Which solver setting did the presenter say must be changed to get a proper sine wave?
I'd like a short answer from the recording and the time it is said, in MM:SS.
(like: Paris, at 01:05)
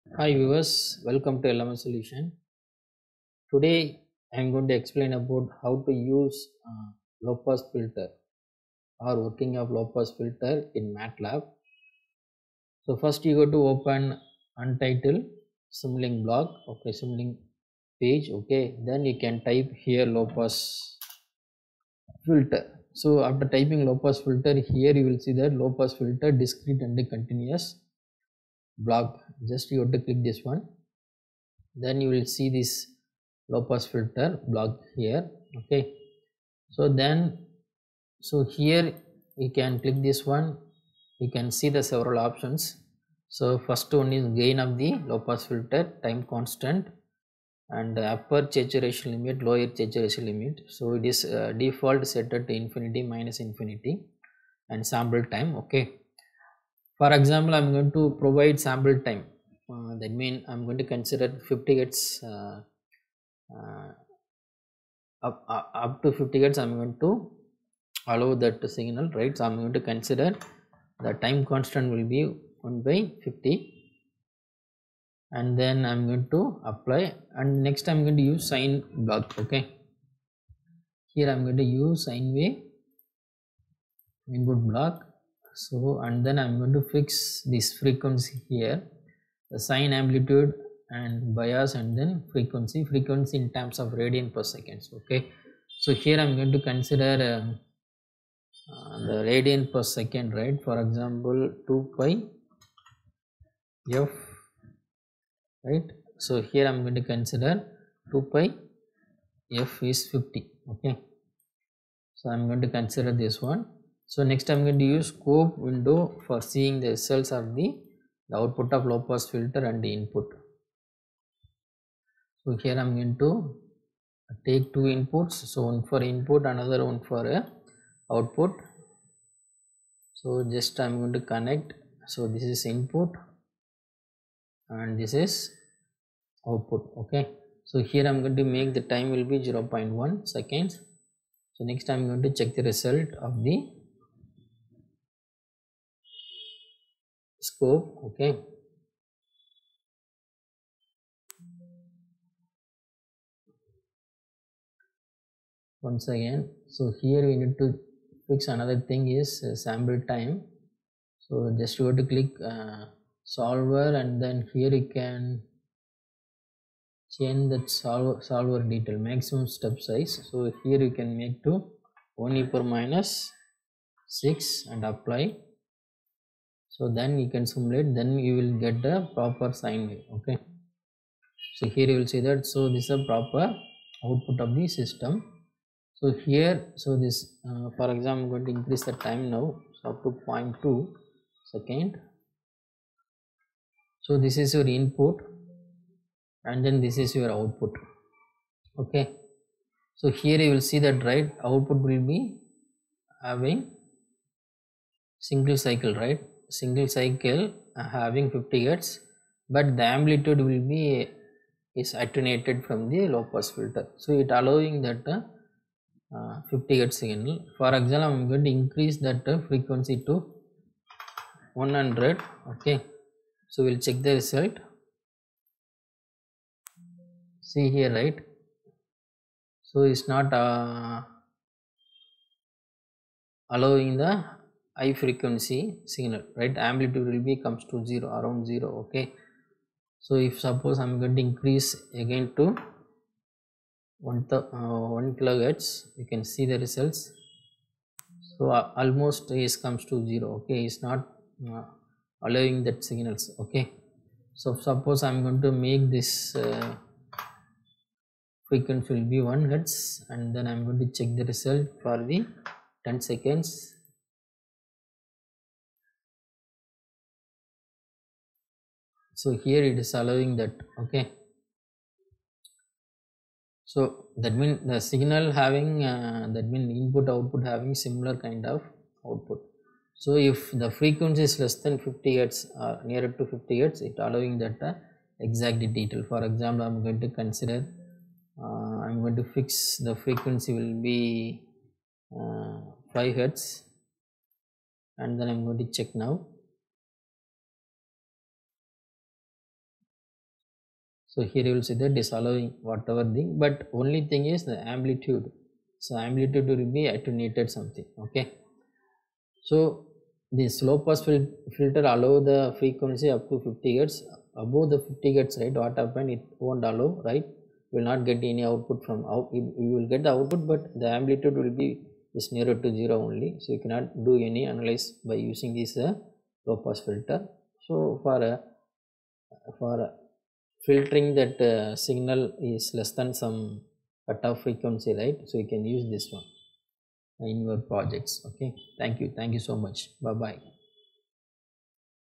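maximum step size, at 02:49.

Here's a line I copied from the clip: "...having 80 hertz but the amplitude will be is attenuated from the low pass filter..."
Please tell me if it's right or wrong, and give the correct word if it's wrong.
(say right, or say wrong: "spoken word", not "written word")
wrong: "50", not "80".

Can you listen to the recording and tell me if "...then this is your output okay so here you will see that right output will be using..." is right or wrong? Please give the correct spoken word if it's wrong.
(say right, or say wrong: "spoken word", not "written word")
wrong: "having", not "using".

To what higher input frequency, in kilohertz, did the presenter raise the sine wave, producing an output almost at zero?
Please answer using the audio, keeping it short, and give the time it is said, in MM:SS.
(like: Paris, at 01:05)
1 kilohertz, at 04:05.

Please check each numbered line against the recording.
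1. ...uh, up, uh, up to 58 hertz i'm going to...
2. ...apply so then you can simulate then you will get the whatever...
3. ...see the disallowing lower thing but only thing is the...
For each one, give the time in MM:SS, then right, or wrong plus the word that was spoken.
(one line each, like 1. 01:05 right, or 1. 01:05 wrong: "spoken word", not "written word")
1. 01:03 wrong: "50", not "58"
2. 02:54 wrong: "proper", not "whatever"
3. 05:01 wrong: "whatever", not "lower".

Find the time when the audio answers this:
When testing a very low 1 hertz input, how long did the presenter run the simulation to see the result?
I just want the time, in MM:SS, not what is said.
04:22.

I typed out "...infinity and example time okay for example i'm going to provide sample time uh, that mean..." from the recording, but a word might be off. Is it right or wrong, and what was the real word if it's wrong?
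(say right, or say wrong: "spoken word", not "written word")
wrong: "sample", not "example".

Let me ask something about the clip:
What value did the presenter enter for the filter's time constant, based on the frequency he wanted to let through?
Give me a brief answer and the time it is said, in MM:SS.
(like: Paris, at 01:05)
1/50, at 01:12.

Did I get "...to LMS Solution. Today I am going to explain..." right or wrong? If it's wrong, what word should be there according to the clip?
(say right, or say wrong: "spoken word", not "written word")
right.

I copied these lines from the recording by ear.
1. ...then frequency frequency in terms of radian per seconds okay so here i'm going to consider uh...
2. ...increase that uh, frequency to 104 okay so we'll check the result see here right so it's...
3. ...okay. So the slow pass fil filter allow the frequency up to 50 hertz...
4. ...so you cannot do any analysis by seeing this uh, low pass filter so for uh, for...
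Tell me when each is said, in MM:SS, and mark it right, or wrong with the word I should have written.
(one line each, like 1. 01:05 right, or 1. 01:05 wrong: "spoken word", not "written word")
1. 01:31 right
2. 03:38 wrong: "100", not "104"
3. 05:08 right
4. 05:23 wrong: "using", not "seeing".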